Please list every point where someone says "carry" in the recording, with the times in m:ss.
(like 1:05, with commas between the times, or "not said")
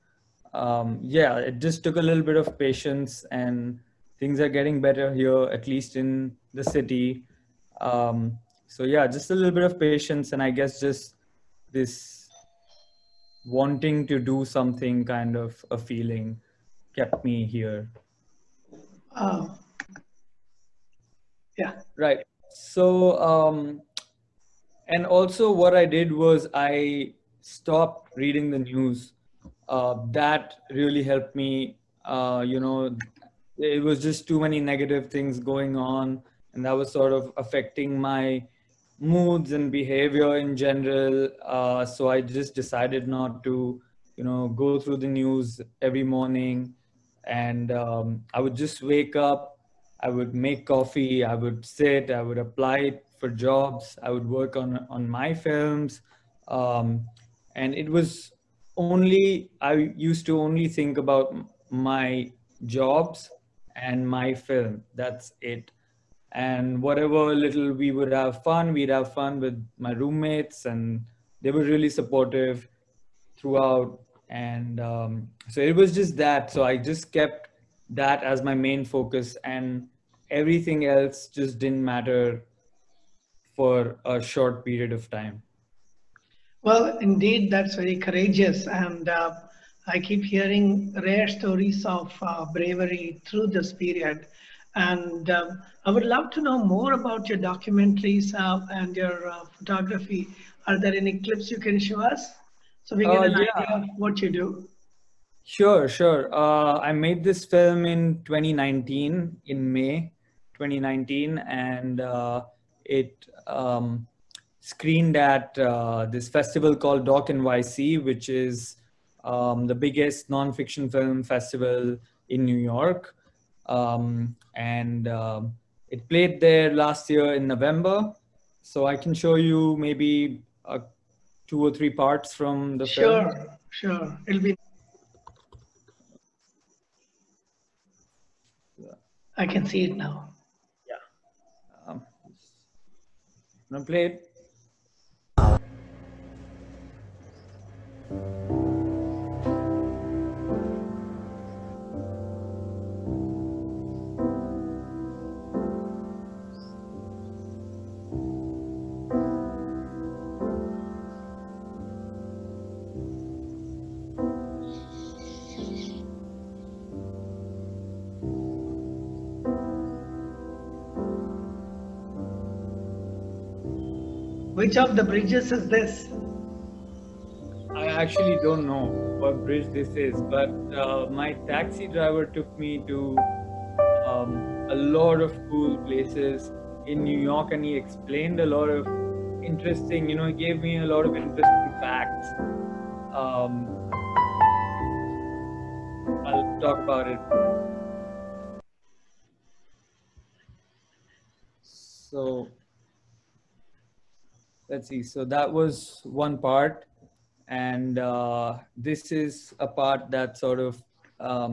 not said.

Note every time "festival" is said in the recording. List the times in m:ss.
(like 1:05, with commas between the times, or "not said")
1:56, 2:01.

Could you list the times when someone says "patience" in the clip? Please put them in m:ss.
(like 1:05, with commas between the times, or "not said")
0:02, 0:09.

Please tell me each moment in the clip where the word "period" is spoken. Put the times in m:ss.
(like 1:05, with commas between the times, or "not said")
1:24, 1:33.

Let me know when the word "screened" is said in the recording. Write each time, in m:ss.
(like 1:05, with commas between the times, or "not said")
1:54.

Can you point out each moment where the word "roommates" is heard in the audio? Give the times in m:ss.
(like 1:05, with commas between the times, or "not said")
1:09.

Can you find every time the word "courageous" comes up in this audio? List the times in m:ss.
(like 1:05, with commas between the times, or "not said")
1:27.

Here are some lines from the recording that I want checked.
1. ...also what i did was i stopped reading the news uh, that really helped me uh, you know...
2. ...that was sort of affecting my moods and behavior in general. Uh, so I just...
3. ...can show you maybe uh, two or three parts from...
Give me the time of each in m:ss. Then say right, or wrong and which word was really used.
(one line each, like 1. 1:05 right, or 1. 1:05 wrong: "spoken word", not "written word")
1. 0:25 right
2. 0:36 right
3. 2:08 right.